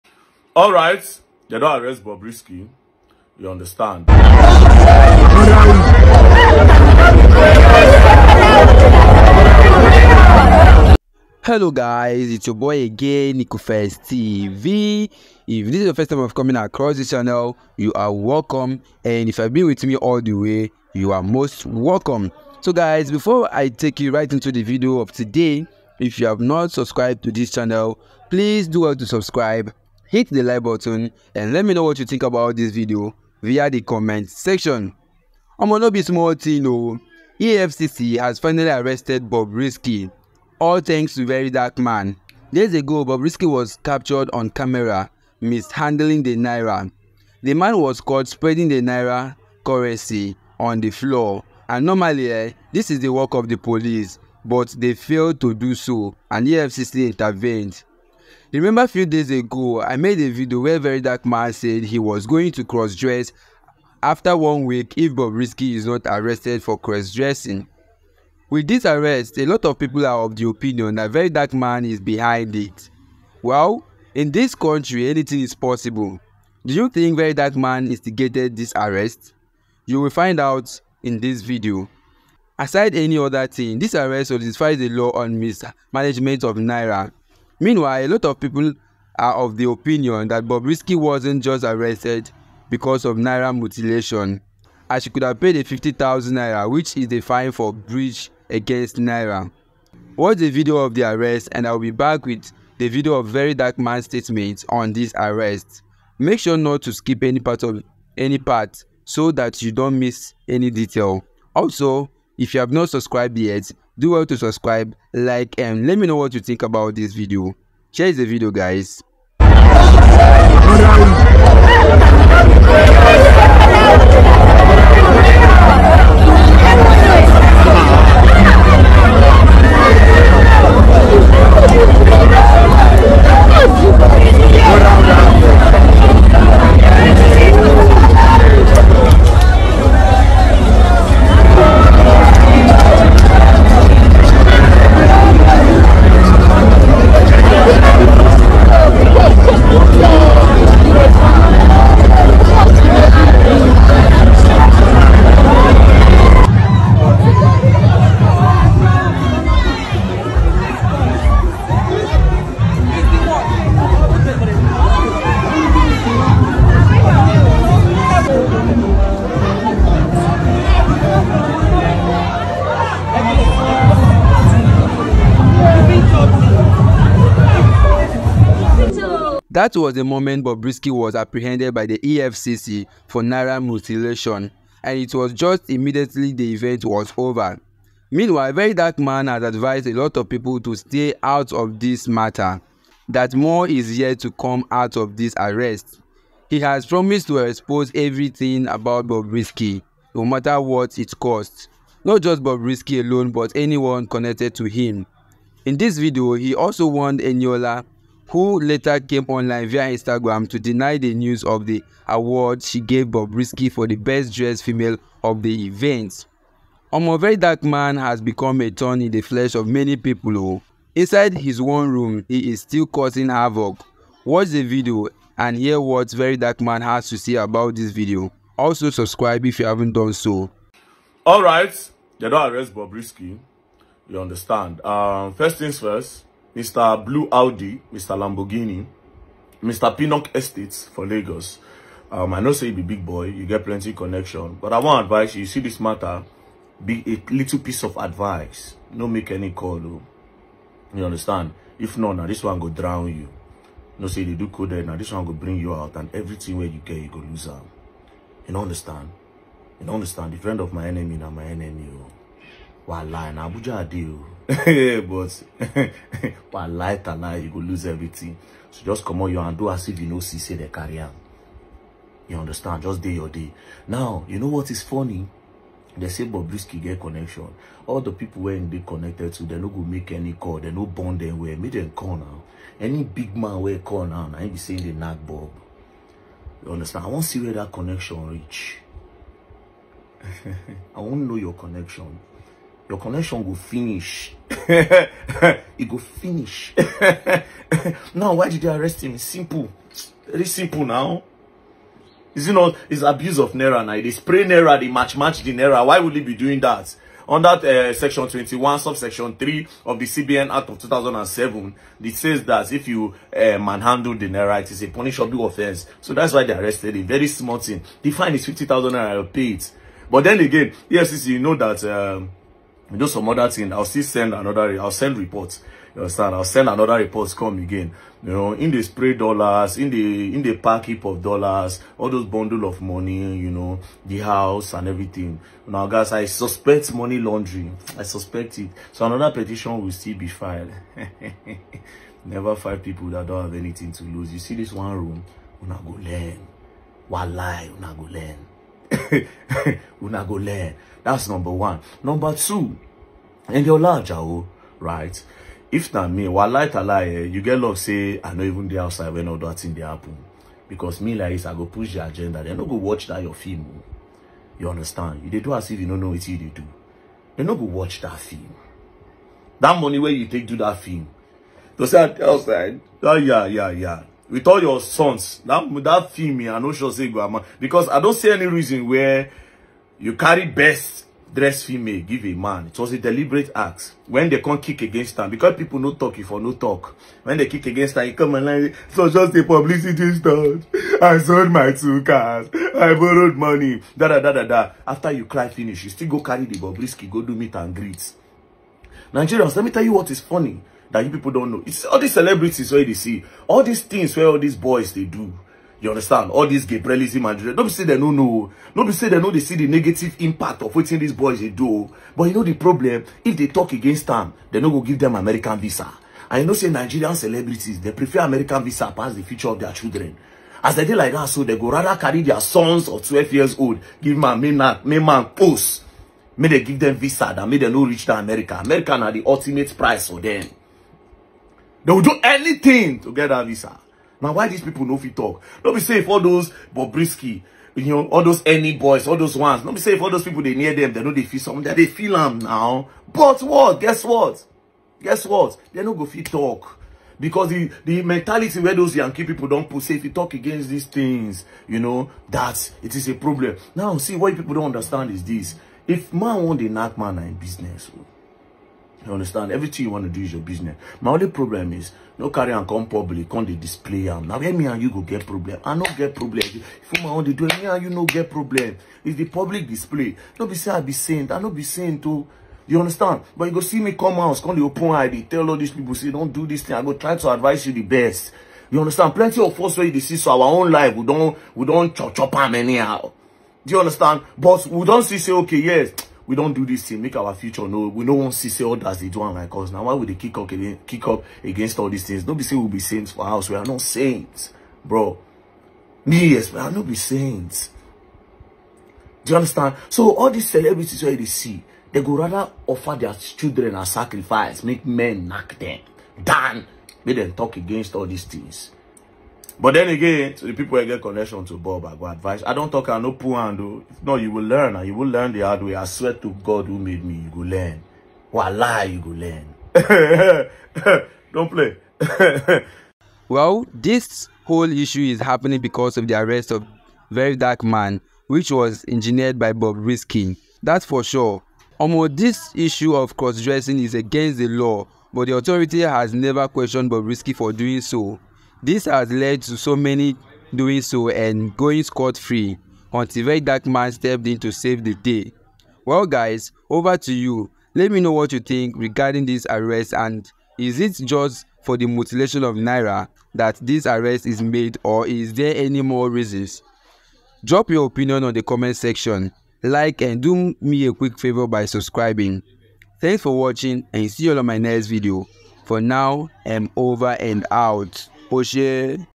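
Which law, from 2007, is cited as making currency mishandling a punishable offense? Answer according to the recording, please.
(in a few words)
CBN Act.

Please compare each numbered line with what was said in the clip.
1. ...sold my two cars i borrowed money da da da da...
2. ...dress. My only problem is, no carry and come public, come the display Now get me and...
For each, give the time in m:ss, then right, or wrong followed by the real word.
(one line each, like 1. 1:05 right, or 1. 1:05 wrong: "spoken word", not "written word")
1. 6:31 right
2. 7:40 wrong: "business", not "dress".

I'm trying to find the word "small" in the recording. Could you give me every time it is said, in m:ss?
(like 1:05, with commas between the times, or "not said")
0:36, 5:17.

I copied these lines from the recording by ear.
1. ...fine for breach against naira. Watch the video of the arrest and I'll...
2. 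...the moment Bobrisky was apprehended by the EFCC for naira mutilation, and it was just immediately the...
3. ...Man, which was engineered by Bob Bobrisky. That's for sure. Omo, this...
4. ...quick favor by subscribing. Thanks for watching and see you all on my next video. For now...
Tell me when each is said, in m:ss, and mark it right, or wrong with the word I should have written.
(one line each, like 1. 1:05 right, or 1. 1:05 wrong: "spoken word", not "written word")
1. 1:37 right
2. 2:59 right
3. 8:47 wrong: "Riskin", not "Bobrisky"
4. 9:20 right.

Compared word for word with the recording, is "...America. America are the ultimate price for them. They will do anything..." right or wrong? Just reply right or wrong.
right.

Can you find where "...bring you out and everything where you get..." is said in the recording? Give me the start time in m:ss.
4:15.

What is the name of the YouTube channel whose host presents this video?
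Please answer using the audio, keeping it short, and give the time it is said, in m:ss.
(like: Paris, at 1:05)
NicoFest TV, at 0:13.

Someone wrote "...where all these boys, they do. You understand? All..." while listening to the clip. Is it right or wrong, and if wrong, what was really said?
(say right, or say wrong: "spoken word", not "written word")
right.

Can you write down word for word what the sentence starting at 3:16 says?
He has promised to expose everything about Bobrisky, no matter what it costs.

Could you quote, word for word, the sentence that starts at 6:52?
But you know the problem, if they talk against them, they no go give them American visa.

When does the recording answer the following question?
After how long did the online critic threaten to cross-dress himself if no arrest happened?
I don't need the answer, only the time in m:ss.
1:04.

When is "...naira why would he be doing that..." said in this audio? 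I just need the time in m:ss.
5:05.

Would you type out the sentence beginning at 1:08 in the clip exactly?
With this arrest, a lot of people are of the opinion that Very Dark Man is behind it.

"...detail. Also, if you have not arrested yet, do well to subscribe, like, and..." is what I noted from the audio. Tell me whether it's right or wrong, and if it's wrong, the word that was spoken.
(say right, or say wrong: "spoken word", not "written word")
wrong: "subscribed", not "arrested".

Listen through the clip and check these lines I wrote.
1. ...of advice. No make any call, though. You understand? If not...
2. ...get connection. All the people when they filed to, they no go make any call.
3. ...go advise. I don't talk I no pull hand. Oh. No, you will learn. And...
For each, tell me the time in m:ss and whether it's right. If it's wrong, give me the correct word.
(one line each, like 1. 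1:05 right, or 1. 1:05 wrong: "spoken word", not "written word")
1. 4:07 right
2. 4:36 wrong: "connected", not "filed"
3. 8:31 right.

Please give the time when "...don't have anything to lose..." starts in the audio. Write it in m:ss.
5:43.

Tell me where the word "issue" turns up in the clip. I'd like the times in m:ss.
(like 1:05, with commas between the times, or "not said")
8:44, 8:52.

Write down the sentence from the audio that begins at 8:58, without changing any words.
This has led to so many doing so and going scot-free until that dark man stepped in to save the day.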